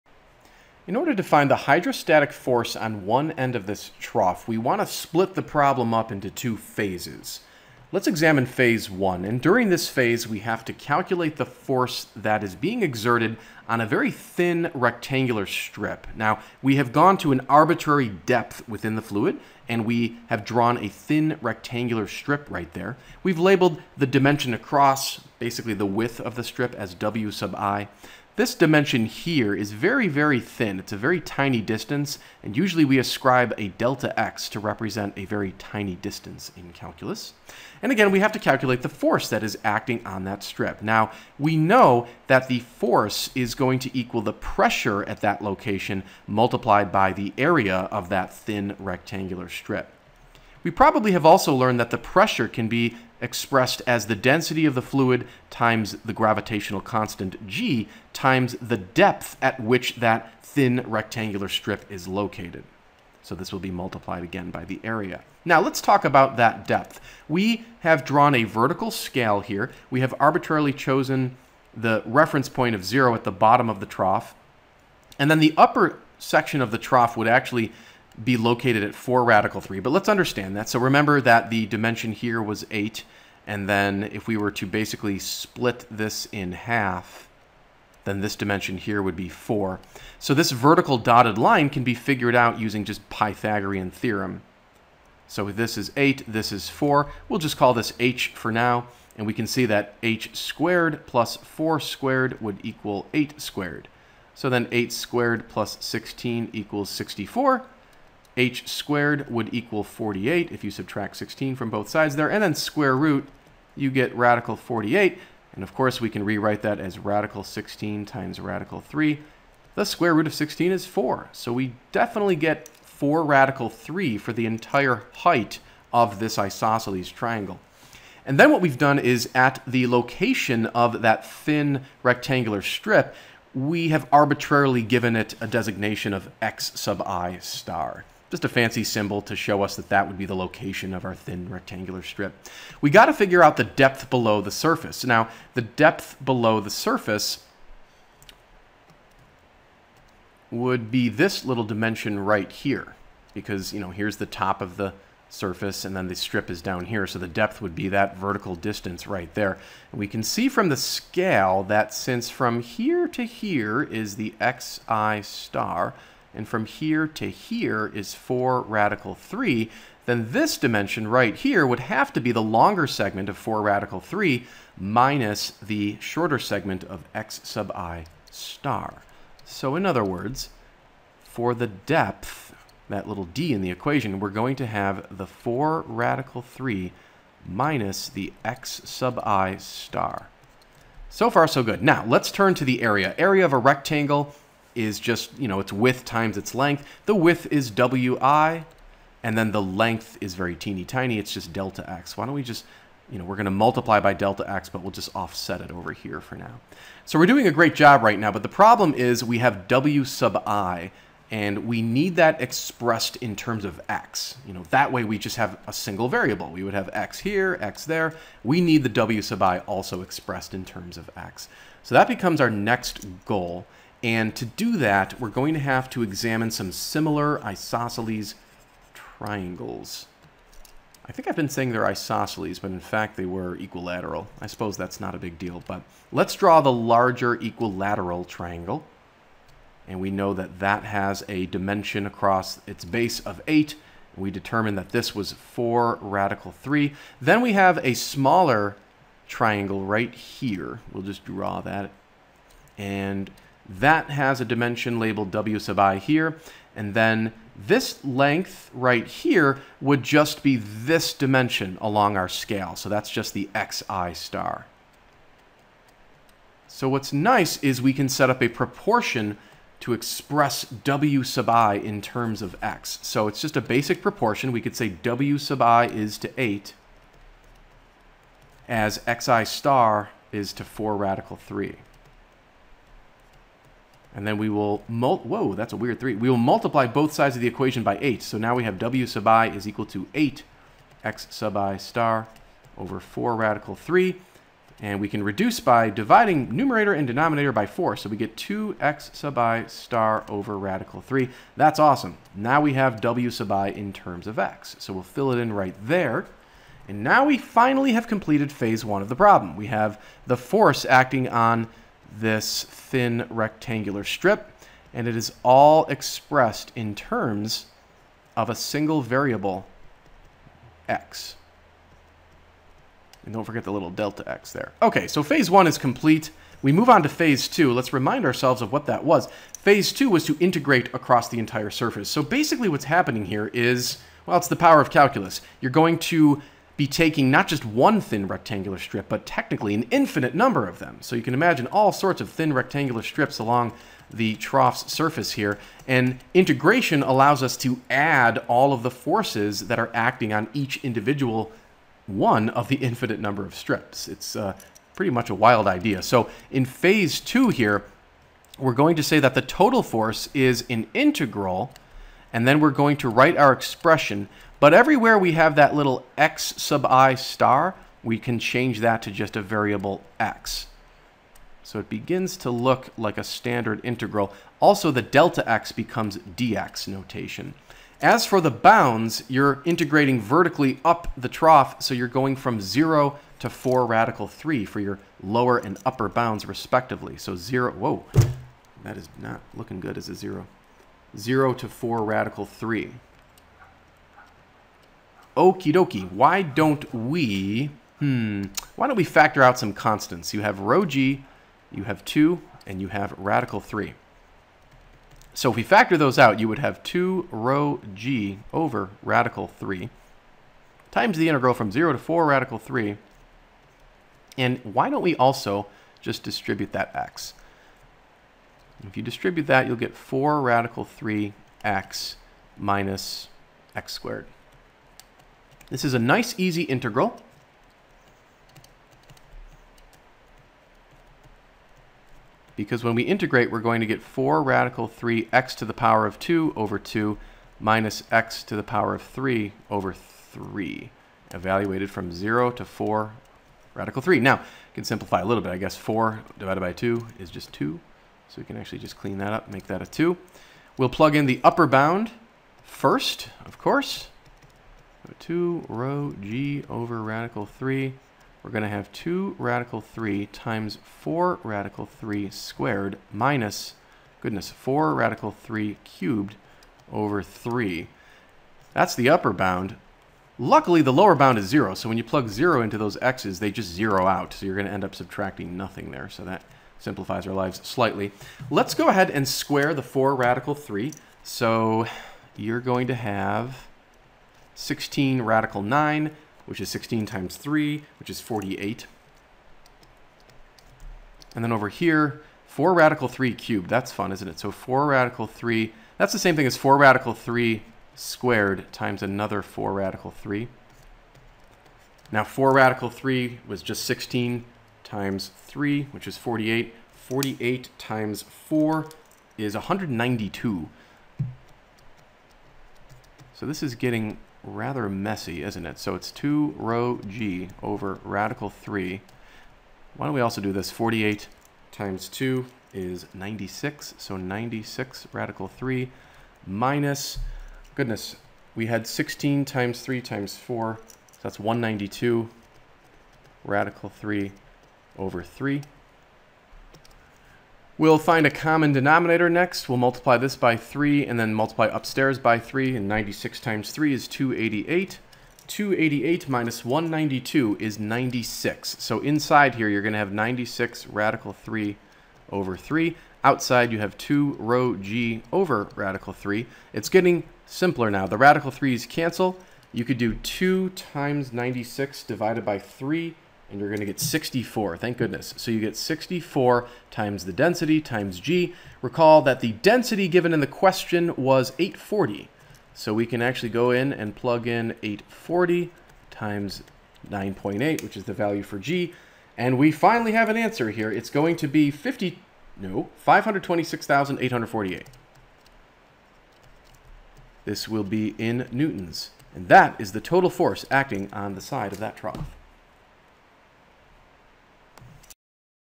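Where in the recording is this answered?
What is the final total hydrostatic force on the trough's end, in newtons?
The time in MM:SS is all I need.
09:42.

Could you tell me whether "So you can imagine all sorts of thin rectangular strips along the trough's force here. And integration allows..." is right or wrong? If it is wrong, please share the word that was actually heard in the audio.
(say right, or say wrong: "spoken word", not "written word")
wrong: "surface", not "force".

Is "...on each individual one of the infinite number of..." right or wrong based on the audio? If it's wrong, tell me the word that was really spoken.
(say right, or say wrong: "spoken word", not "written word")
right.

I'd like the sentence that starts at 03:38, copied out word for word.
We need the w sub i also expressed in terms of x.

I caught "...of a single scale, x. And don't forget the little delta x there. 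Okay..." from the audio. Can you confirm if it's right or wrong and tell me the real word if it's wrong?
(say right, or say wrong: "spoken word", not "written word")
wrong: "variable", not "scale".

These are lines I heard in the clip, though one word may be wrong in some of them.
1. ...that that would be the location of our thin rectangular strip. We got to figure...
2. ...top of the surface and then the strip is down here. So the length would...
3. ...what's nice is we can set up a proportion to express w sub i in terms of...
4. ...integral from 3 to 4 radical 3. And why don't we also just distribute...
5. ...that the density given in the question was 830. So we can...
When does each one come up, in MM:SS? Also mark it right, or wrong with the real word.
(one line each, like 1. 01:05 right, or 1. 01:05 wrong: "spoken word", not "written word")
1. 02:19 right
2. 02:34 wrong: "depth", not "length"
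3. 04:26 right
4. 06:51 wrong: "0", not "3"
5. 09:29 wrong: "840", not "830".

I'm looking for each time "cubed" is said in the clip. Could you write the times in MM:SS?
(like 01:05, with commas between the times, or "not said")
07:45, 08:13.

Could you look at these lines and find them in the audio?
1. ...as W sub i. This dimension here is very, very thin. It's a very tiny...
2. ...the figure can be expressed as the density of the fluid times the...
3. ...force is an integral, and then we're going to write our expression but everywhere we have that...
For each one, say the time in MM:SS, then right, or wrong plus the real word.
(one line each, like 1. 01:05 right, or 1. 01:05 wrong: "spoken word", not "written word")
1. 00:26 right
2. 00:51 wrong: "pressure", not "figure"
3. 05:59 right.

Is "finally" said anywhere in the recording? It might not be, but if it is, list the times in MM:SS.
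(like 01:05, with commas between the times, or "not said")
05:07, 09:39.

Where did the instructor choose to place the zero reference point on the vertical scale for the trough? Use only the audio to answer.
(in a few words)
bottom of the trough.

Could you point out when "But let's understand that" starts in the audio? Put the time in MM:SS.
01:19.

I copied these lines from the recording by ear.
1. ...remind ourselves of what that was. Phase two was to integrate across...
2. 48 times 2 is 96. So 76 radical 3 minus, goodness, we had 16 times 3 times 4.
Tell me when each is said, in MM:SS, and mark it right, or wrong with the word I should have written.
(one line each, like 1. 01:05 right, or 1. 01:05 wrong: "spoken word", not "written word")
1. 05:27 right
2. 08:40 wrong: "96", not "76".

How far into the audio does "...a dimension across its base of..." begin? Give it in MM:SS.
04:01.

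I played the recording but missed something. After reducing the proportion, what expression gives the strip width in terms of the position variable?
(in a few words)
2x sub i star over radical 3.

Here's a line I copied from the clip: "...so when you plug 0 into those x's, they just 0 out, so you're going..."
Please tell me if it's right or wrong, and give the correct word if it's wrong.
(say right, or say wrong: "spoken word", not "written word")
right.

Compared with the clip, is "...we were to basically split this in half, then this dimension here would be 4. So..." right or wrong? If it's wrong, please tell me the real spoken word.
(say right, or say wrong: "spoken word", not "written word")
right.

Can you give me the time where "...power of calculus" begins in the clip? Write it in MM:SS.
05:34.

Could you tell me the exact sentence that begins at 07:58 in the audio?
Let's go ahead and square the 4 radical 3.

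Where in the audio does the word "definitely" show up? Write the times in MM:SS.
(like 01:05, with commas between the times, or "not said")
02:01.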